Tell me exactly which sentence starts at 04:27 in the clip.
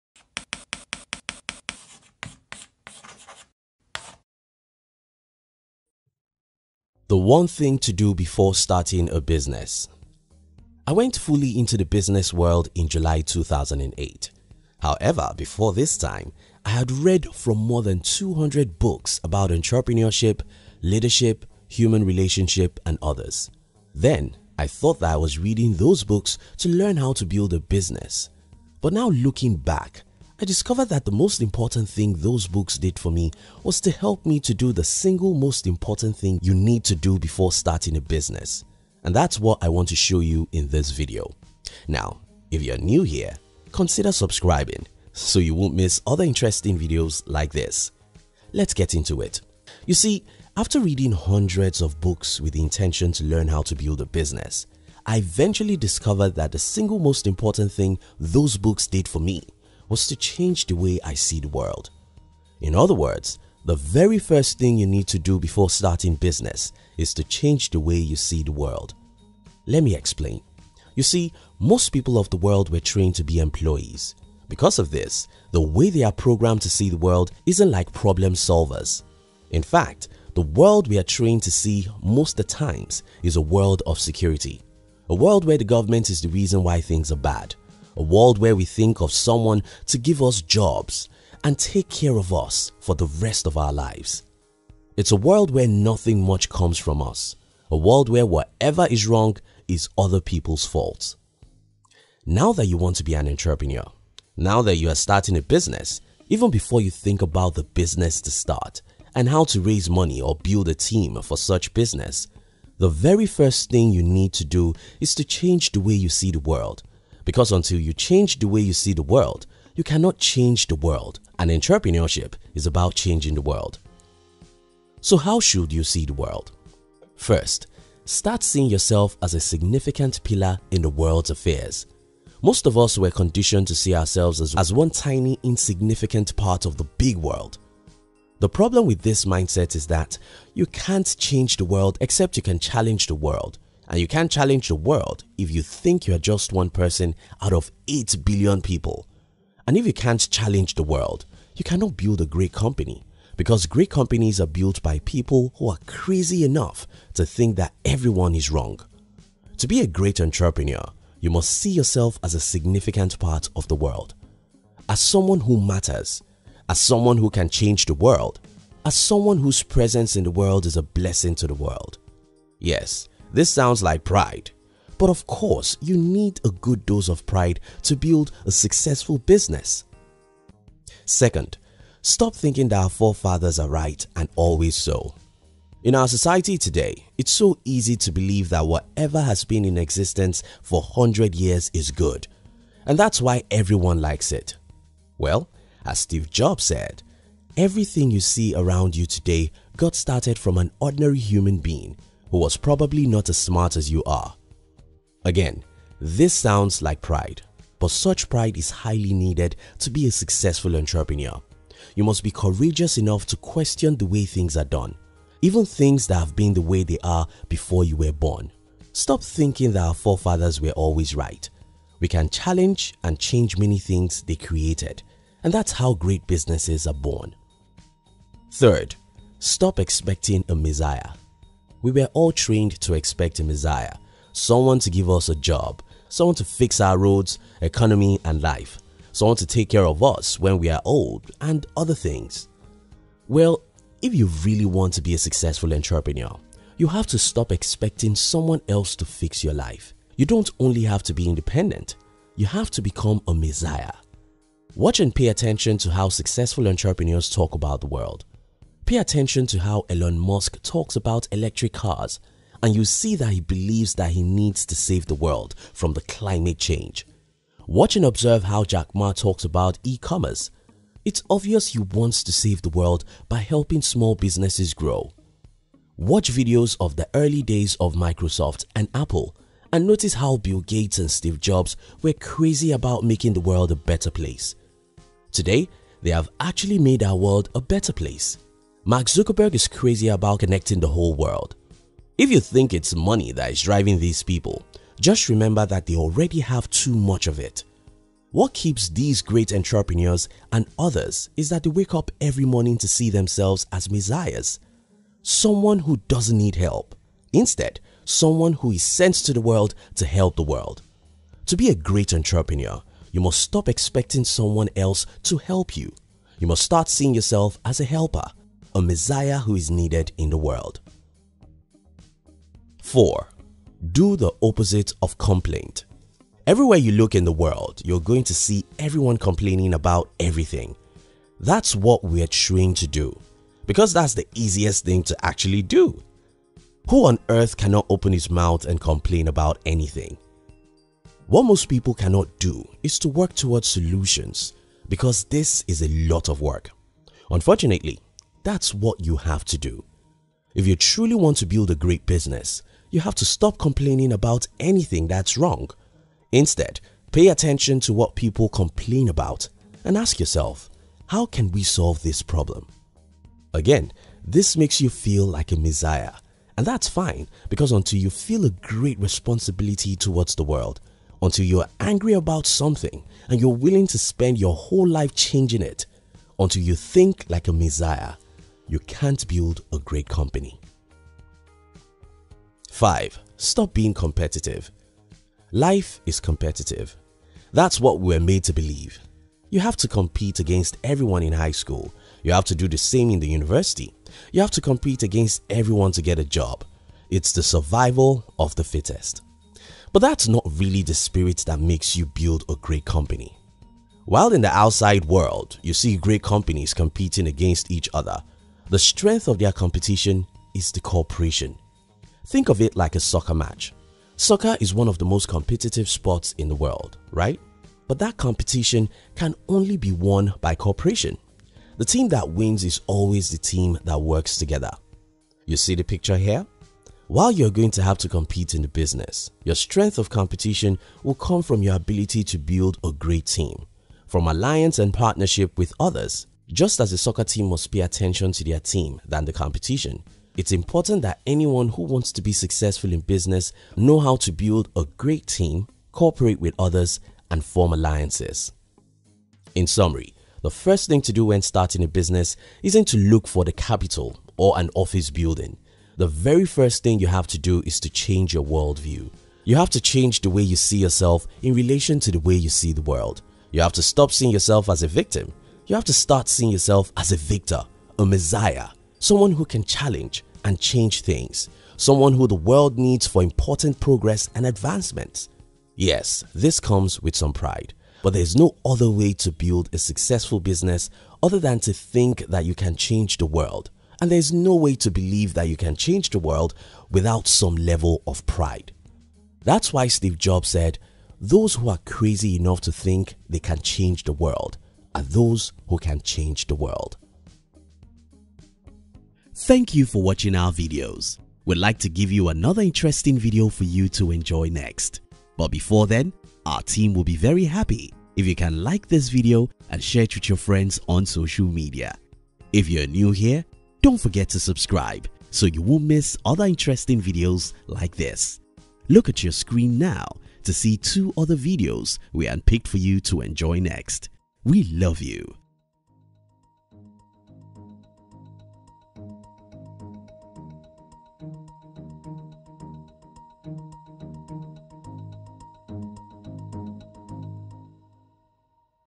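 Watch and observe how Jack Ma talks about e-commerce.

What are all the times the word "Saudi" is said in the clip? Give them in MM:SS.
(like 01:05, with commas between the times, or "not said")
not said.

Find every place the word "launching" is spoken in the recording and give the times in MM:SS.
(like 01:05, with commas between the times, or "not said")
not said.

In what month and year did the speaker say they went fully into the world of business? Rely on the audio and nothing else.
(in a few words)
July 2008.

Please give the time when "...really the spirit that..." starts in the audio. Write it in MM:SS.
06:40.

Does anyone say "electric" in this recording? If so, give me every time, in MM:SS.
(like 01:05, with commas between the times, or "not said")
04:21.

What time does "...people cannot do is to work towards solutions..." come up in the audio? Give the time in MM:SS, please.
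05:41.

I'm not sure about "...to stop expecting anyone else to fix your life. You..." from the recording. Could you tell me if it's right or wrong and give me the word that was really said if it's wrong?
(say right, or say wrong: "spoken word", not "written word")
wrong: "someone", not "anyone".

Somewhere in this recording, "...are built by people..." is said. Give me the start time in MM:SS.
02:34.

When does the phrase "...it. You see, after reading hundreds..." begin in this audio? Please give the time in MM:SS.
00:49.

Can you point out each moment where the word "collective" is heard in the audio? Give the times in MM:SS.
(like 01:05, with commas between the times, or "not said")
not said.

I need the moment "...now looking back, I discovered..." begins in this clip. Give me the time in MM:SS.
00:28.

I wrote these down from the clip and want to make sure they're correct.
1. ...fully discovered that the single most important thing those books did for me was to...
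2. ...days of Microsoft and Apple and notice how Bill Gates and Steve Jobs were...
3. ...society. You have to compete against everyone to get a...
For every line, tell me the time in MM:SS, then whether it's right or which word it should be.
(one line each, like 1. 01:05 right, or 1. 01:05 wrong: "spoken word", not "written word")
1. 00:55 wrong: "eventually", not "fully"
2. 04:37 right
3. 06:33 wrong: "university", not "society".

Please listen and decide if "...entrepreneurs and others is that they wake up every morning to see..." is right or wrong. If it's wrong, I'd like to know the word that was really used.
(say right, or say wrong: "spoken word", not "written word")
right.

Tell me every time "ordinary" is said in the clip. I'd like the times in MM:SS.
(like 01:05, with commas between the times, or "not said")
03:20.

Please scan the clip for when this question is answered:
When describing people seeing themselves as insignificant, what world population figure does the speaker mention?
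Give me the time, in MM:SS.
02:27.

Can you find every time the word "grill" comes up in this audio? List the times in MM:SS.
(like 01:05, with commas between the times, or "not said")
not said.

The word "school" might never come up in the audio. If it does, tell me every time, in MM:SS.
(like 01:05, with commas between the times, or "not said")
06:31.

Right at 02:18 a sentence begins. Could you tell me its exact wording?
The problem with this mindset is that you can't change the world except you can challenge the world.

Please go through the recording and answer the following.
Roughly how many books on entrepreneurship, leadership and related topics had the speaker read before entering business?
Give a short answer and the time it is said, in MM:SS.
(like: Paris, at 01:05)
more than 200, at 00:17.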